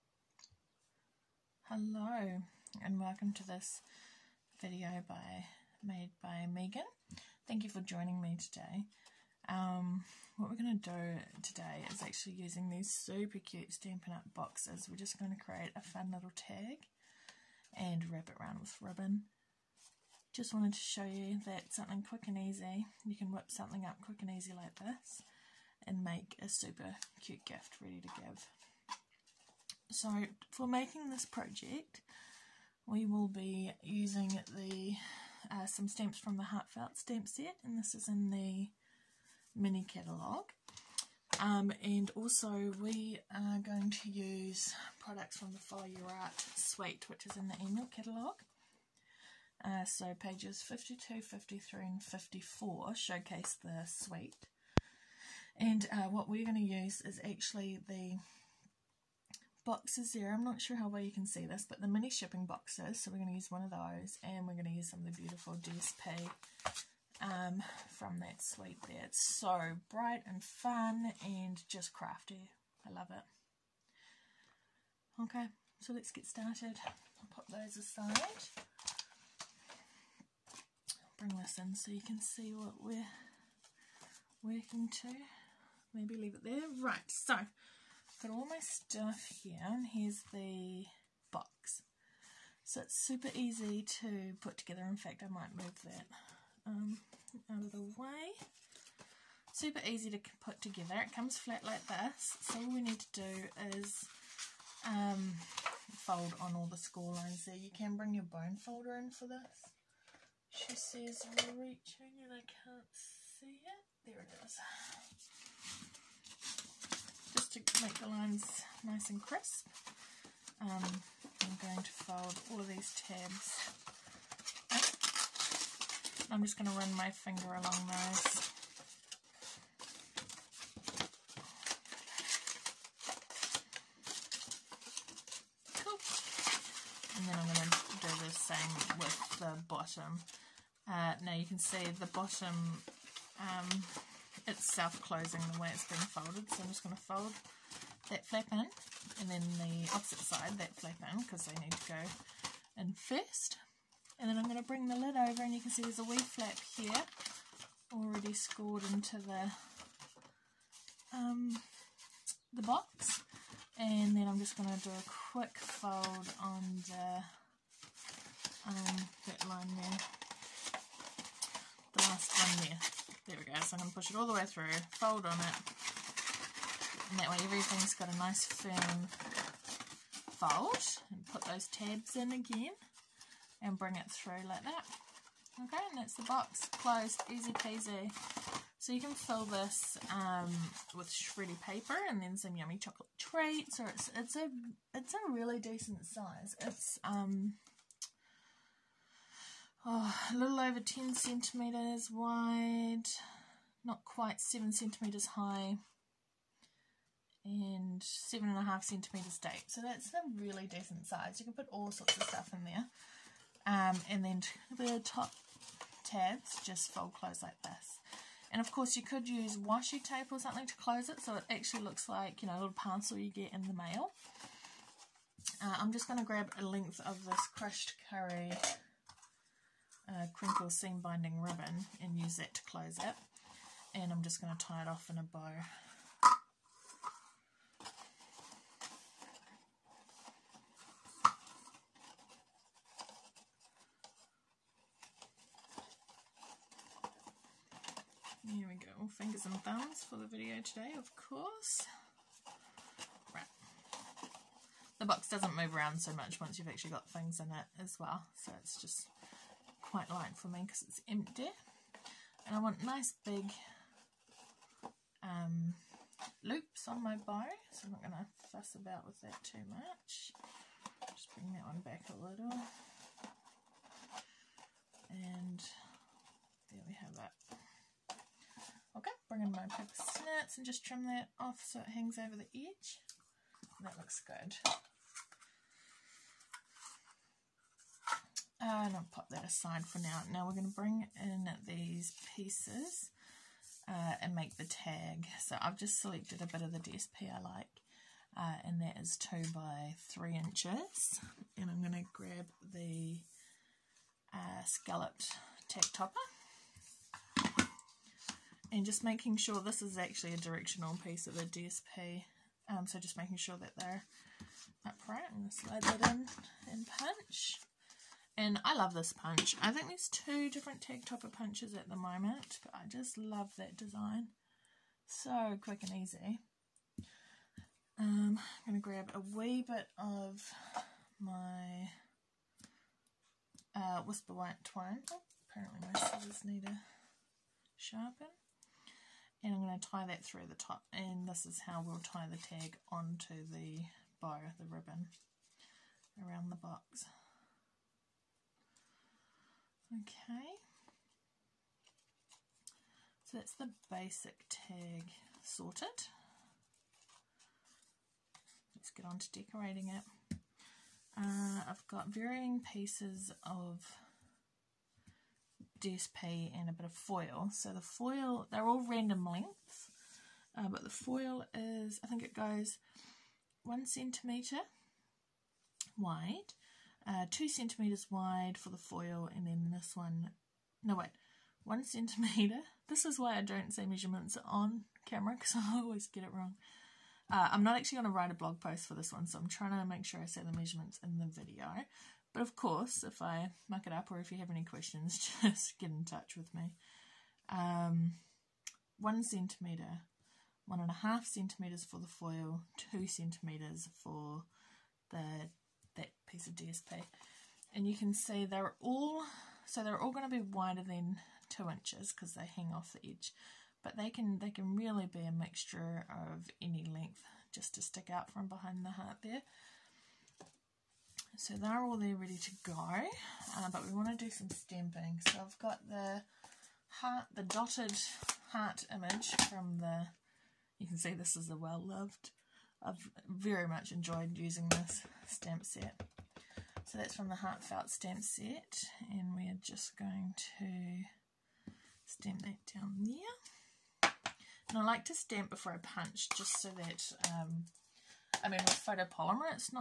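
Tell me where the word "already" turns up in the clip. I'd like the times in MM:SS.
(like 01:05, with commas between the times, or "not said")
02:37.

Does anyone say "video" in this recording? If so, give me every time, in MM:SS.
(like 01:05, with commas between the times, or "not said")
00:04, 04:10, 06:31.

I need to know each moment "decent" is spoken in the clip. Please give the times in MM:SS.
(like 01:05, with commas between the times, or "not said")
03:15, 03:30.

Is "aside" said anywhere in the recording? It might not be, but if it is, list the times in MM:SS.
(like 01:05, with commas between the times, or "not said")
01:17, 04:49.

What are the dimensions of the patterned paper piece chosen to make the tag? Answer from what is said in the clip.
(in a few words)
2 by 3 inches.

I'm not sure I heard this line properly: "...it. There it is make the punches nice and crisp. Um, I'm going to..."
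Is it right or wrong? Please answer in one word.
wrong.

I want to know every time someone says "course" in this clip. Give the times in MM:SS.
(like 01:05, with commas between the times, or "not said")
03:38, 04:11, 06:32.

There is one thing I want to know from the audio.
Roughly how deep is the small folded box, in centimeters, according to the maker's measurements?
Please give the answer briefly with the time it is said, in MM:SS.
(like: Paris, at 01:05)
7.5 centimeters, at 03:28.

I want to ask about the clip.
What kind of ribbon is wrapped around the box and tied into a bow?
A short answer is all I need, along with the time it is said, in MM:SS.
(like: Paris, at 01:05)
Crinkle seam binding ribbon, at 03:50.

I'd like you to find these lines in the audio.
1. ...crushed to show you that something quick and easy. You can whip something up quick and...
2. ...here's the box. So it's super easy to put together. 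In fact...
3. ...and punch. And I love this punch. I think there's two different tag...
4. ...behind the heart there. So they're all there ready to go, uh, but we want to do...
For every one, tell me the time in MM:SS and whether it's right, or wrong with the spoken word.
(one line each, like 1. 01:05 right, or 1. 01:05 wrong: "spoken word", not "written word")
1. 00:20 wrong: "wanted", not "crushed"
2. 01:29 right
3. 05:16 right
4. 06:58 right.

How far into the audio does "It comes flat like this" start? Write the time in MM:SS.
01:41.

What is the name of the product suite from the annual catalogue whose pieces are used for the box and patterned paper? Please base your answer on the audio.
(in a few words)
Follow Your Art.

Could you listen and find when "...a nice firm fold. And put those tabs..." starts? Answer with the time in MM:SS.
02:58.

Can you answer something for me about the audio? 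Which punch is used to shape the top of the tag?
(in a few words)
Scalloped tag topper.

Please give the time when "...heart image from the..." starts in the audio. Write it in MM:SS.
07:08.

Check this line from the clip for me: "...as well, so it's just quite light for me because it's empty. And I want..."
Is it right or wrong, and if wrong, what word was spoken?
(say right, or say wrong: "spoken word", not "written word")
right.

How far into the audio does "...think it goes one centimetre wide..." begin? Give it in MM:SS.
06:12.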